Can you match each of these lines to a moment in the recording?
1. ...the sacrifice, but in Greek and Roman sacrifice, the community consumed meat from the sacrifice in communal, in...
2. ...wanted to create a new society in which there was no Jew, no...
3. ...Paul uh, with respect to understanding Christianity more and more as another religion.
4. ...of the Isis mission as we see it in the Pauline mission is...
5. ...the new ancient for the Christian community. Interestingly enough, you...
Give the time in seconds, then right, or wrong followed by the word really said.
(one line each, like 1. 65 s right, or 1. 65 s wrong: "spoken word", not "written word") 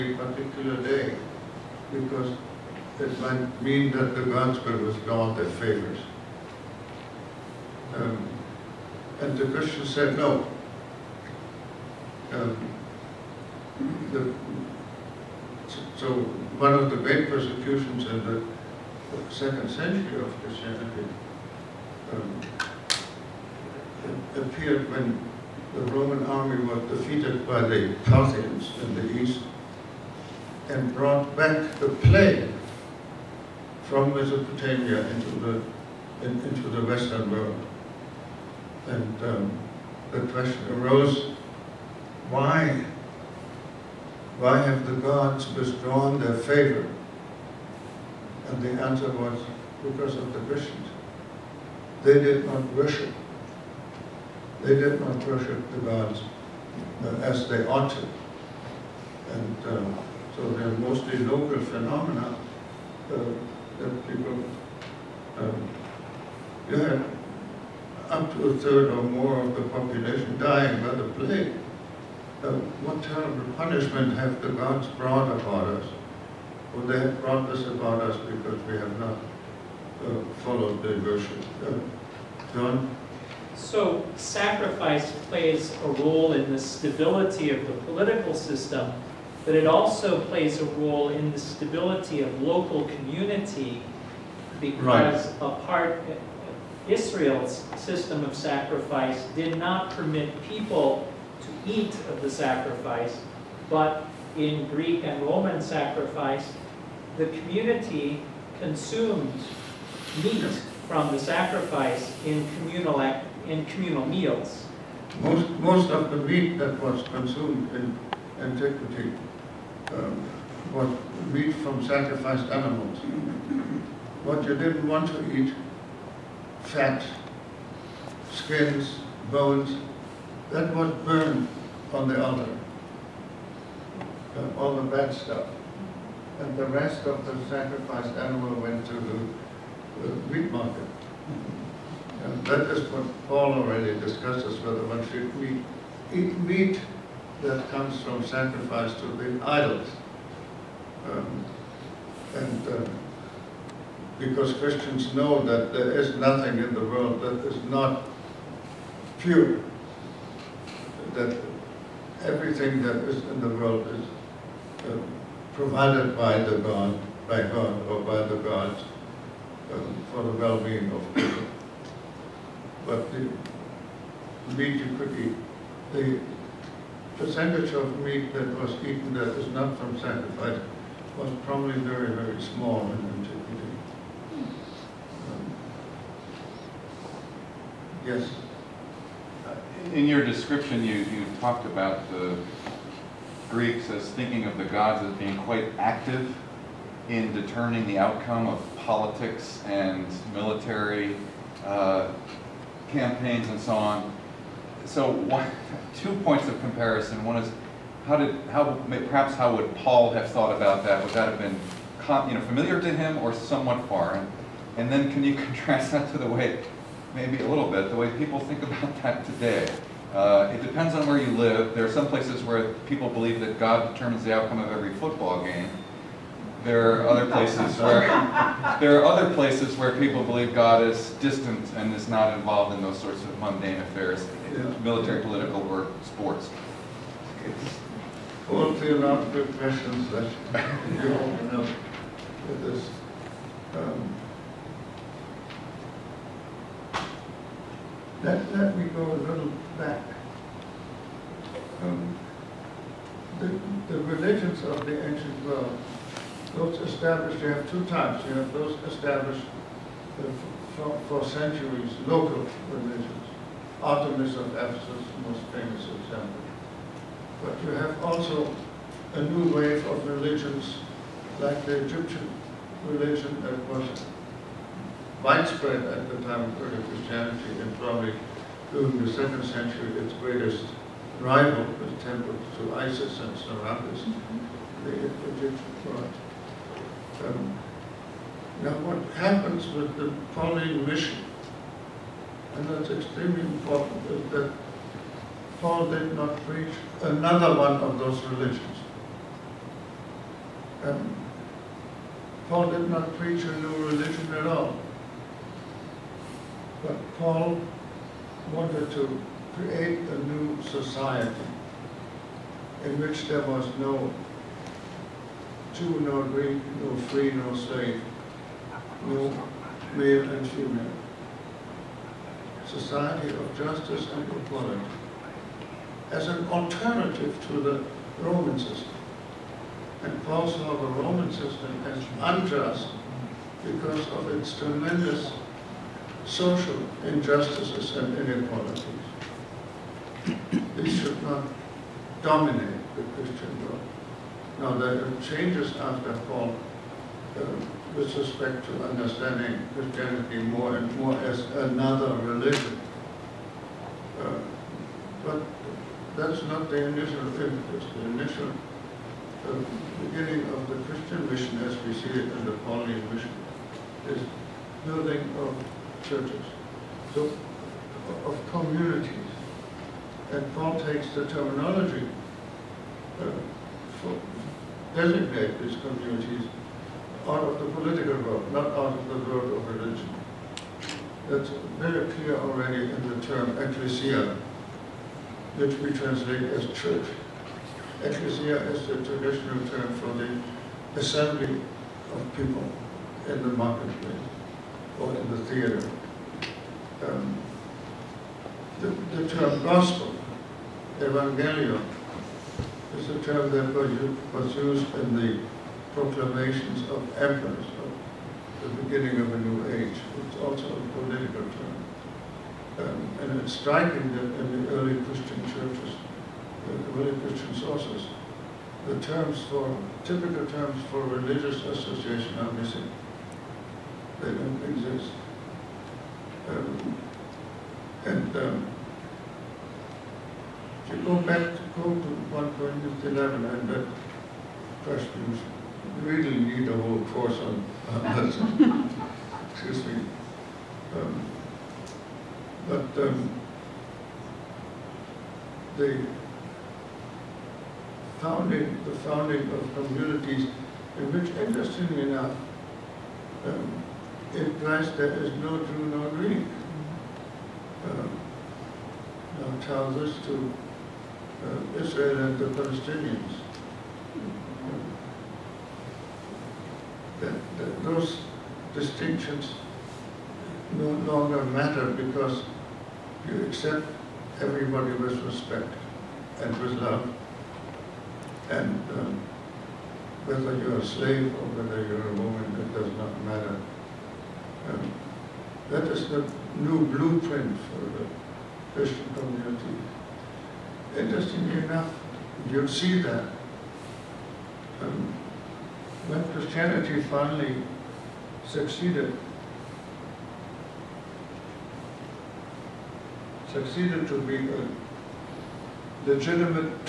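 1. 102 s right
2. 308 s right
3. 346 s right
4. 360 s wrong: "Christian", not "Isis"
5. 486 s wrong: "blueprint", not "ancient".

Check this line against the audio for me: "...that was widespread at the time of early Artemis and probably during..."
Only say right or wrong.
wrong.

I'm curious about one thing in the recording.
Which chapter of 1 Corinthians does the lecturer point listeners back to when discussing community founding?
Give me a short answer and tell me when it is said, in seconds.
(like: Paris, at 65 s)
11, at 433 s.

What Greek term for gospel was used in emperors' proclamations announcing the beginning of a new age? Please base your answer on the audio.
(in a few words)
Evangelion.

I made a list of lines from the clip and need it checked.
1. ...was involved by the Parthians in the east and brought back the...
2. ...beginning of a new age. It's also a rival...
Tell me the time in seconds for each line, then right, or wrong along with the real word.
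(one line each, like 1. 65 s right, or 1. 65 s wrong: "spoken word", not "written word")
1. 26 s wrong: "defeated", not "involved"
2. 408 s wrong: "political", not "rival".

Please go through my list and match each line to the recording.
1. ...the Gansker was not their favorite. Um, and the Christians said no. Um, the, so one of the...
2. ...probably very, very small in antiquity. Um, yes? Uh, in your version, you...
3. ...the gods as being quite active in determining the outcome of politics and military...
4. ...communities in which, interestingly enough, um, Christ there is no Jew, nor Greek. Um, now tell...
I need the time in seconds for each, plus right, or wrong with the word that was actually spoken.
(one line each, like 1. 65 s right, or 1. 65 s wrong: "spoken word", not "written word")
1. 4 s right
2. 181 s wrong: "description", not "version"
3. 194 s right
4. 449 s right.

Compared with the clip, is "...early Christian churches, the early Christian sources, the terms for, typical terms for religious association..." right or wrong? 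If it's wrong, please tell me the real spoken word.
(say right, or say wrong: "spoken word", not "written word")
right.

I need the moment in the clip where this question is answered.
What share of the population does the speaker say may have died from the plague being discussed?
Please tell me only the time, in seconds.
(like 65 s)
68 s.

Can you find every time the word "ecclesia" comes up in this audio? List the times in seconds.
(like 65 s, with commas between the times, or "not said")
383 s, 388 s.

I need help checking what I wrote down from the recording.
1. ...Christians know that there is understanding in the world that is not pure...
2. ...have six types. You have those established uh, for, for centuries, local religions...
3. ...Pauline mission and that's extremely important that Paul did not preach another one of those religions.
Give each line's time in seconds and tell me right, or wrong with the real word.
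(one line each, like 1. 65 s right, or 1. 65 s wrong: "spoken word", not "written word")
1. 154 s wrong: "nothing", not "understanding"
2. 257 s wrong: "two", not "six"
3. 290 s right.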